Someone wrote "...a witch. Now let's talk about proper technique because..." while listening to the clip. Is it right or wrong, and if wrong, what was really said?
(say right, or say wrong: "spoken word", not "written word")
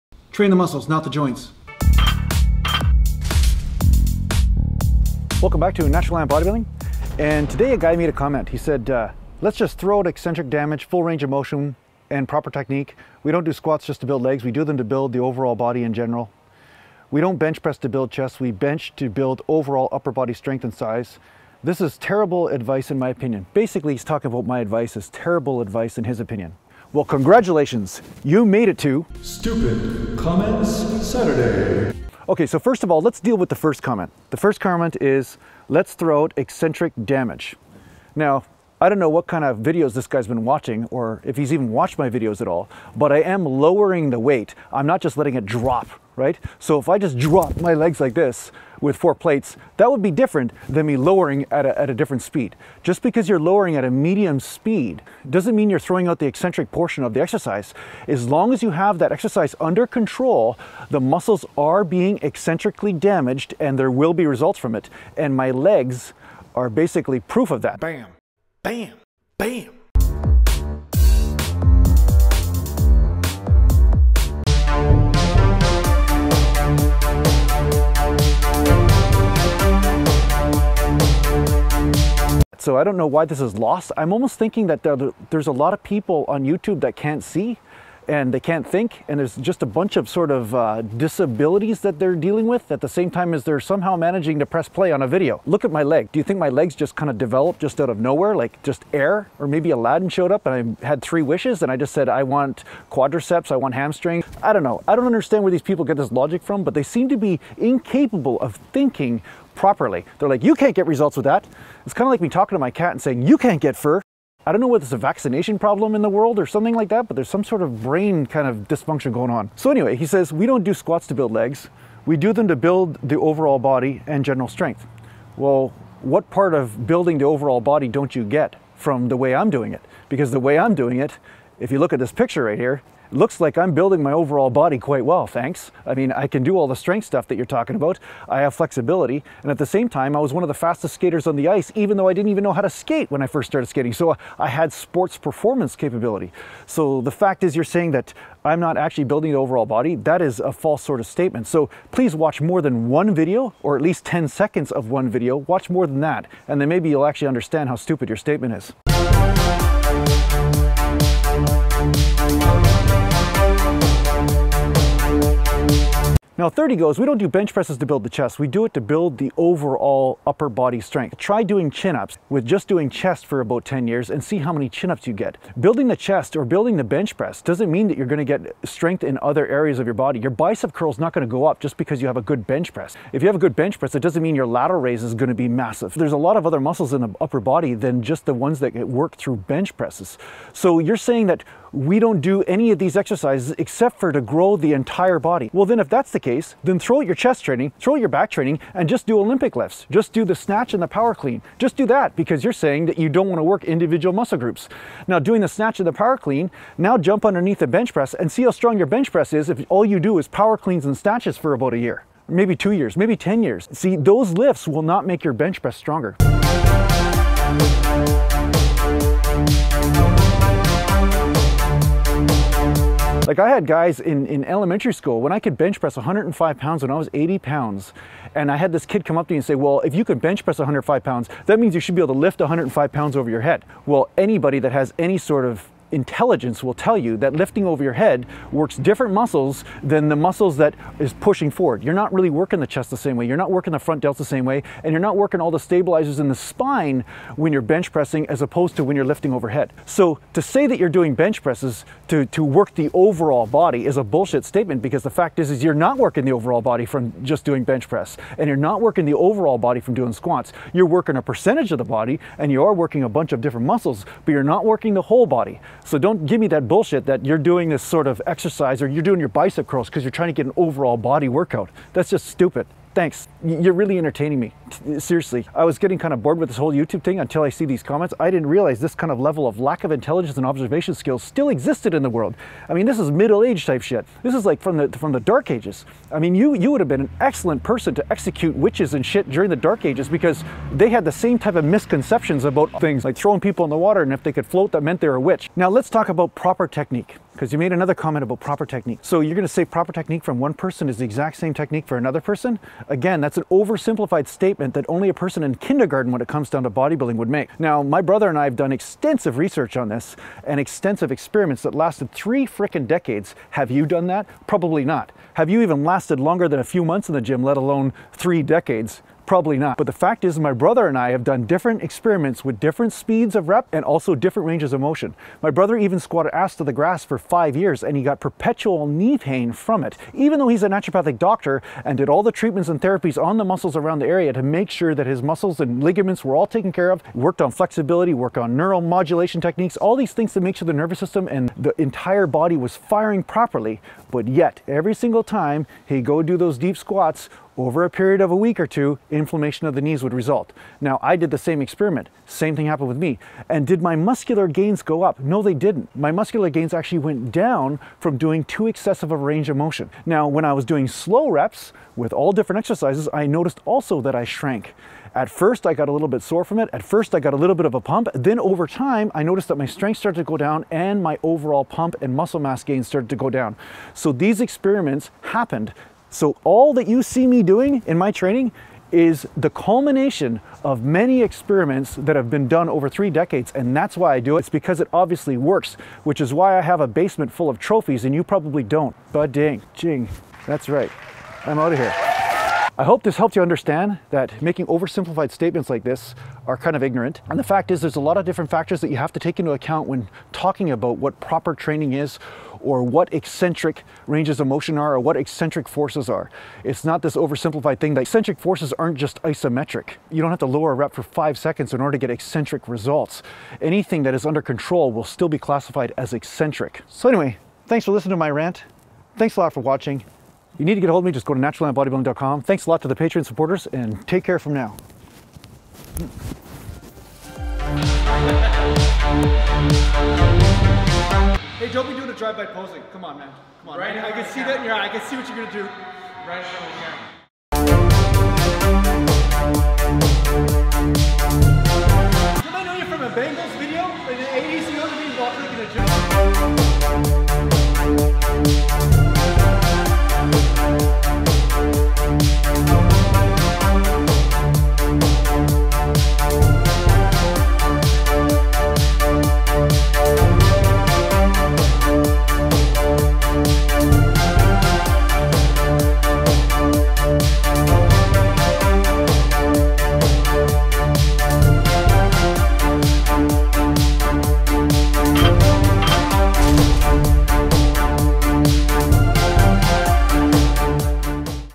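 right.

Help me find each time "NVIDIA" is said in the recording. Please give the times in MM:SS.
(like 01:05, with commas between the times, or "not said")
not said.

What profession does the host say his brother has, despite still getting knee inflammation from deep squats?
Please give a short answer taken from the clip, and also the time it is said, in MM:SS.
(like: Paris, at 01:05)
naturopathic doctor, at 05:30.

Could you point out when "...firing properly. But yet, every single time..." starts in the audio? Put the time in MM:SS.
05:42.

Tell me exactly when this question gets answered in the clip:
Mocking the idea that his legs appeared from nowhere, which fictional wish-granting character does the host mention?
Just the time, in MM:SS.
01:39.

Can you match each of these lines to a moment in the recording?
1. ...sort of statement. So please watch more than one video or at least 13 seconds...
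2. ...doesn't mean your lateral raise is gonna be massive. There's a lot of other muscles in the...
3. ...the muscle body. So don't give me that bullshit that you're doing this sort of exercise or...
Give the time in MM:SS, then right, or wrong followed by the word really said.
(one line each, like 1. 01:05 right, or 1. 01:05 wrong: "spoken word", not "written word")
1. 02:30 wrong: "10", not "13"
2. 03:04 right
3. 04:24 wrong: "whole", not "muscle".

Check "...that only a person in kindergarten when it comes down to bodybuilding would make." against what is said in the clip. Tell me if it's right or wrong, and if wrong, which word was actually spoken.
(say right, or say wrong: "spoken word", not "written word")
right.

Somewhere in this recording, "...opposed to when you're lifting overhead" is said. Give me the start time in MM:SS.
04:08.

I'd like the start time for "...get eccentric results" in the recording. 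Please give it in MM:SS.
06:51.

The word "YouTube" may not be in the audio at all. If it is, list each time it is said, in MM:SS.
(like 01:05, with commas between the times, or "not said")
01:26, 04:36.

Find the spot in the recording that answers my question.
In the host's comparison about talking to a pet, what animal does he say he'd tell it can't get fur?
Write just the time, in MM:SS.
01:52.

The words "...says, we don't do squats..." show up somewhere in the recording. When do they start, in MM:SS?
02:00.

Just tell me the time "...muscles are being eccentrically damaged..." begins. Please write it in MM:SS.
01:00.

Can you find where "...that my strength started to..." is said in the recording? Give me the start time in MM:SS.
06:09.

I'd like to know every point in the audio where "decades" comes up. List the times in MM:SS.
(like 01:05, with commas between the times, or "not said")
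05:12, 05:18, 06:23.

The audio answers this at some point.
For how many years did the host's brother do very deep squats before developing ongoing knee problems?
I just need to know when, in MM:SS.
05:27.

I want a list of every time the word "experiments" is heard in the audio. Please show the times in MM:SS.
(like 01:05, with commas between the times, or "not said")
05:11, 05:21, 05:51, 06:14, 06:21.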